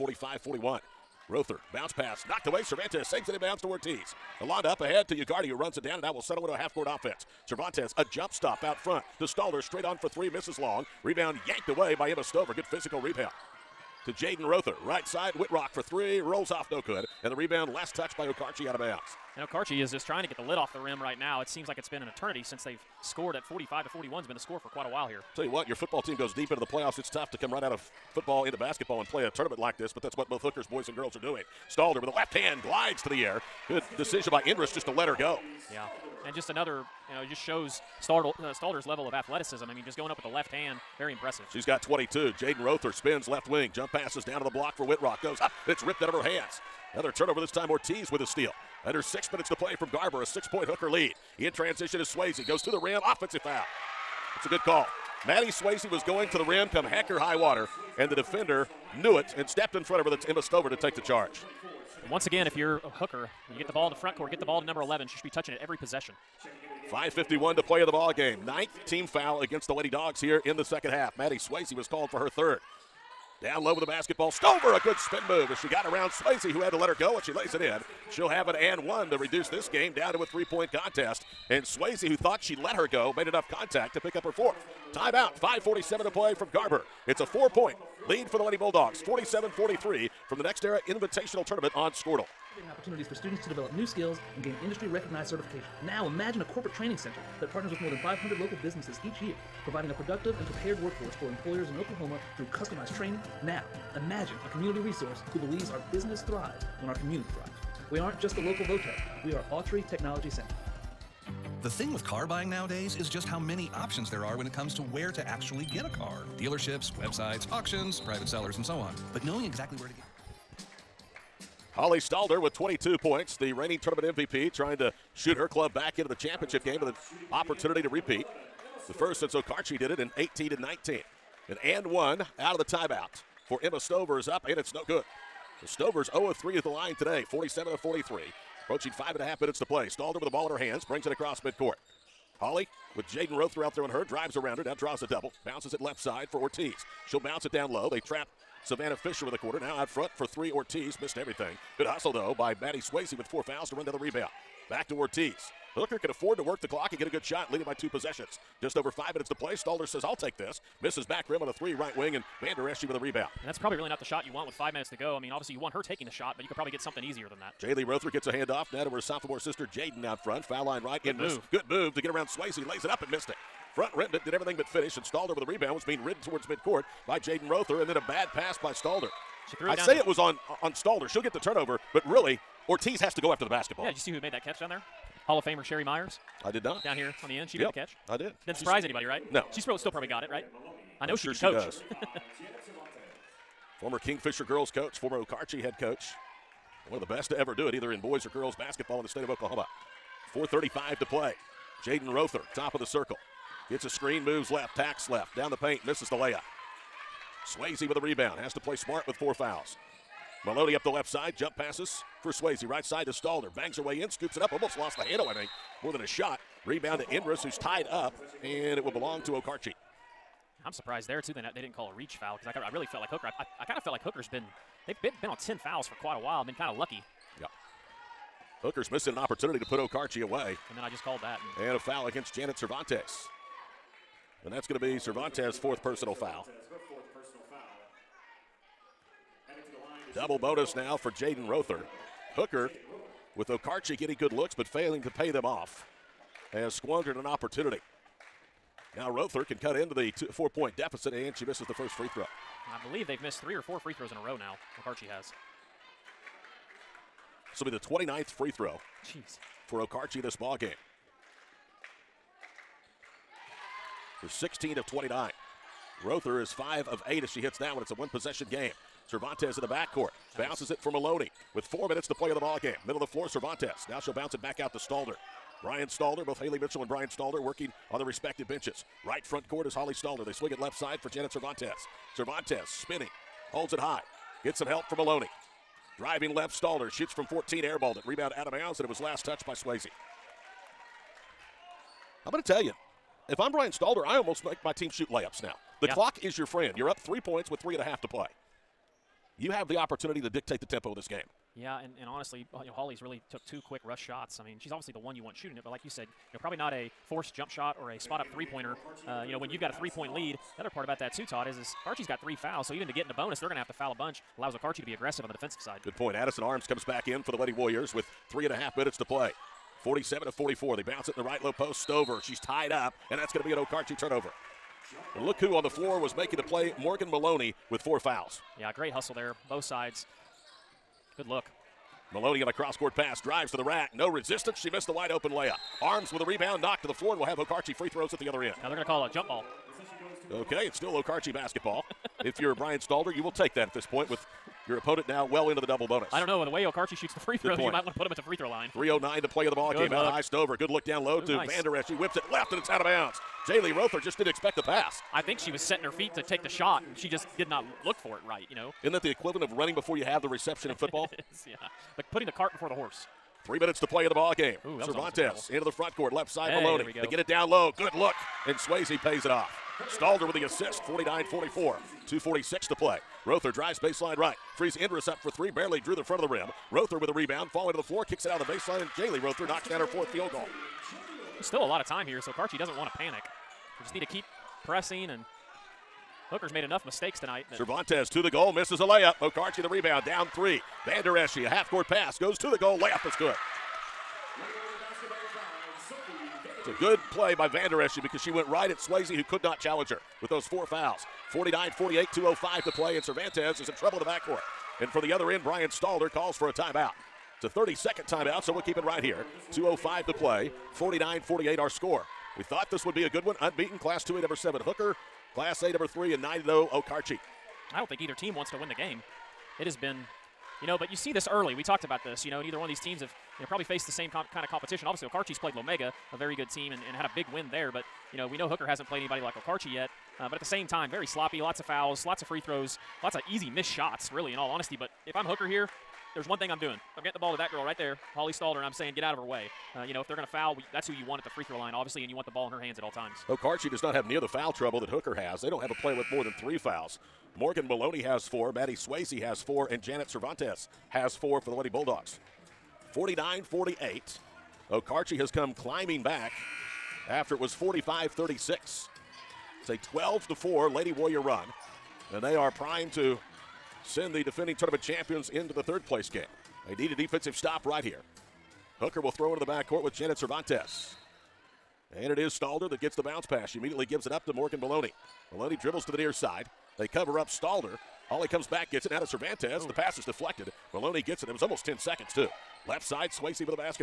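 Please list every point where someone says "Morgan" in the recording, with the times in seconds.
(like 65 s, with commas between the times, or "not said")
326 s, 447 s, 474 s.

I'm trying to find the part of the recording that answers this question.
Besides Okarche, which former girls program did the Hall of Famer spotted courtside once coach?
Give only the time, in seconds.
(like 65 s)
193 s.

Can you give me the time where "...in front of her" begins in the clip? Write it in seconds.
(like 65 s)
59 s.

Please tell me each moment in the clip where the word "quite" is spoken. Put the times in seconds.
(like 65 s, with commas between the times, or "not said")
24 s, 226 s.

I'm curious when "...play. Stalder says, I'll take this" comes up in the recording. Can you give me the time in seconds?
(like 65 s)
159 s.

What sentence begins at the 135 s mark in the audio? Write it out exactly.
The Stovers 0 of 3 at the line today, 47 of 43.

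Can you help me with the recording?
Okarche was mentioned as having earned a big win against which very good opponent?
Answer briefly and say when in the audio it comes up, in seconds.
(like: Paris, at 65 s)
Lomega, at 425 s.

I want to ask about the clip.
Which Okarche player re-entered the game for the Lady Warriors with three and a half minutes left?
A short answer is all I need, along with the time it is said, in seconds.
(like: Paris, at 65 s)
Addison Arms, at 316 s.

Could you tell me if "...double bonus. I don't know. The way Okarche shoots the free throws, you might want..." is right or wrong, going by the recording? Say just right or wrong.
right.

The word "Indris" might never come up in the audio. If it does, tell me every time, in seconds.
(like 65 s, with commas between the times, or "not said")
34 s, 217 s, 374 s.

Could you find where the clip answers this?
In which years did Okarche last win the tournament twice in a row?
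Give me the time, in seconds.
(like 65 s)
130 s.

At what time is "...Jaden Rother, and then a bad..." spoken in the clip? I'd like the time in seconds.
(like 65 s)
177 s.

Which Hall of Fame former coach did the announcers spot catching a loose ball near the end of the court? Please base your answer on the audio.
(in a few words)
Sherry Myers.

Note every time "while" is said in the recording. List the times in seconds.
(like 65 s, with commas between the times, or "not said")
24 s, 226 s.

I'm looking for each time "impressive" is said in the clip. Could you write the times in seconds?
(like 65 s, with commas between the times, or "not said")
41 s.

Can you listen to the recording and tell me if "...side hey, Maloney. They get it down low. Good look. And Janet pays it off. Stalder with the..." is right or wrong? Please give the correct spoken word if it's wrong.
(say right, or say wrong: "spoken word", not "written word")
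wrong: "Swayze", not "Janet".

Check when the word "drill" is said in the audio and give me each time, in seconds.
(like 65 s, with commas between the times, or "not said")
not said.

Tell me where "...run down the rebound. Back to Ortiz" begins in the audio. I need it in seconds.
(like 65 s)
153 s.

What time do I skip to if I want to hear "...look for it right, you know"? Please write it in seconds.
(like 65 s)
357 s.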